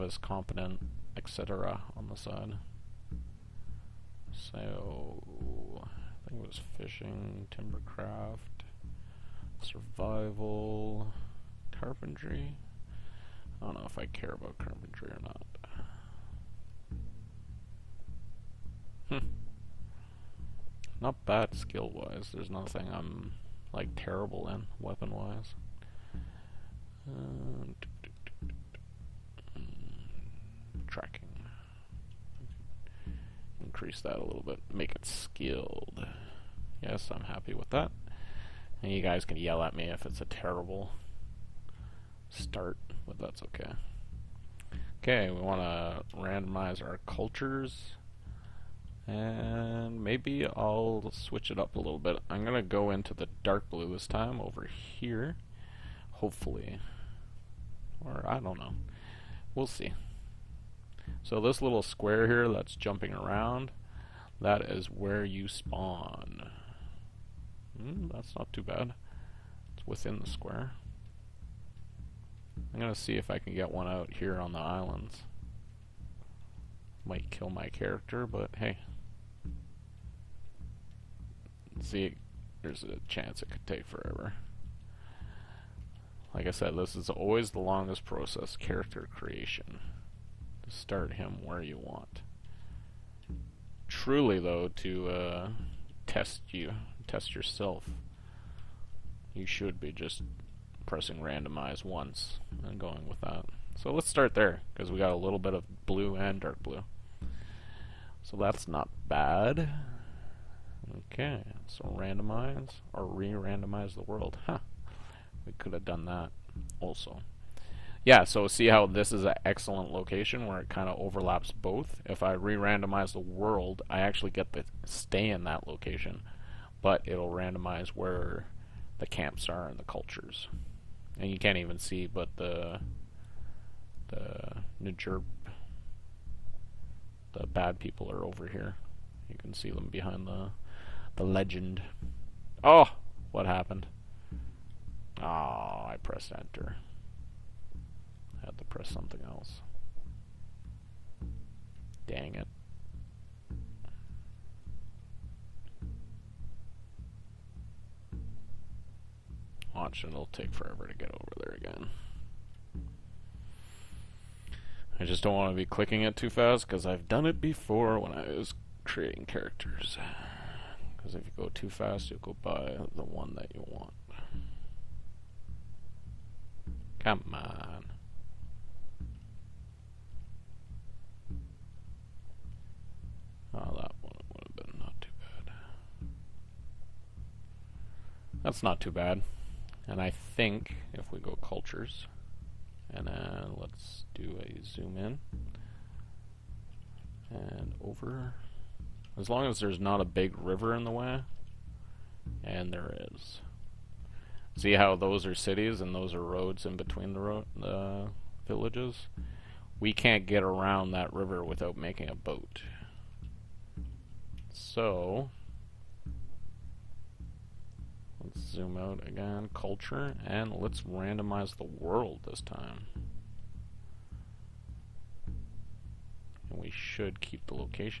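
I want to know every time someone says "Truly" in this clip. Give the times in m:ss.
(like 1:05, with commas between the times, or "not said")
1:33.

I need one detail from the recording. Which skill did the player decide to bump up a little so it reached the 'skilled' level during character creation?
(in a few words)
Tracking.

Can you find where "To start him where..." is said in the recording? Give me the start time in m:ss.
1:30.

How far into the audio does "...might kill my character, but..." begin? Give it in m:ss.
1:17.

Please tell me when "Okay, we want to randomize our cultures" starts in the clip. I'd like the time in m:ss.
0:45.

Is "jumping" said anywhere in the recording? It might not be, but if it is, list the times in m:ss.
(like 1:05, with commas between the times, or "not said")
1:02.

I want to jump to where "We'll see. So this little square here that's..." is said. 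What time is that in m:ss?
0:59.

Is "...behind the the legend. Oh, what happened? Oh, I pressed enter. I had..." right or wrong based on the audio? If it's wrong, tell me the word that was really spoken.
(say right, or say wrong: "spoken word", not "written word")
right.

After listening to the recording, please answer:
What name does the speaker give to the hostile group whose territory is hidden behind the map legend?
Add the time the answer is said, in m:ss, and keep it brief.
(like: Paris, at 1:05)
Nijerp, at 2:14.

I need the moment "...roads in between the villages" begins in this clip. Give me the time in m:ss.
3:26.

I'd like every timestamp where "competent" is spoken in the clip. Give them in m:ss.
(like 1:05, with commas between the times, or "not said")
0:00.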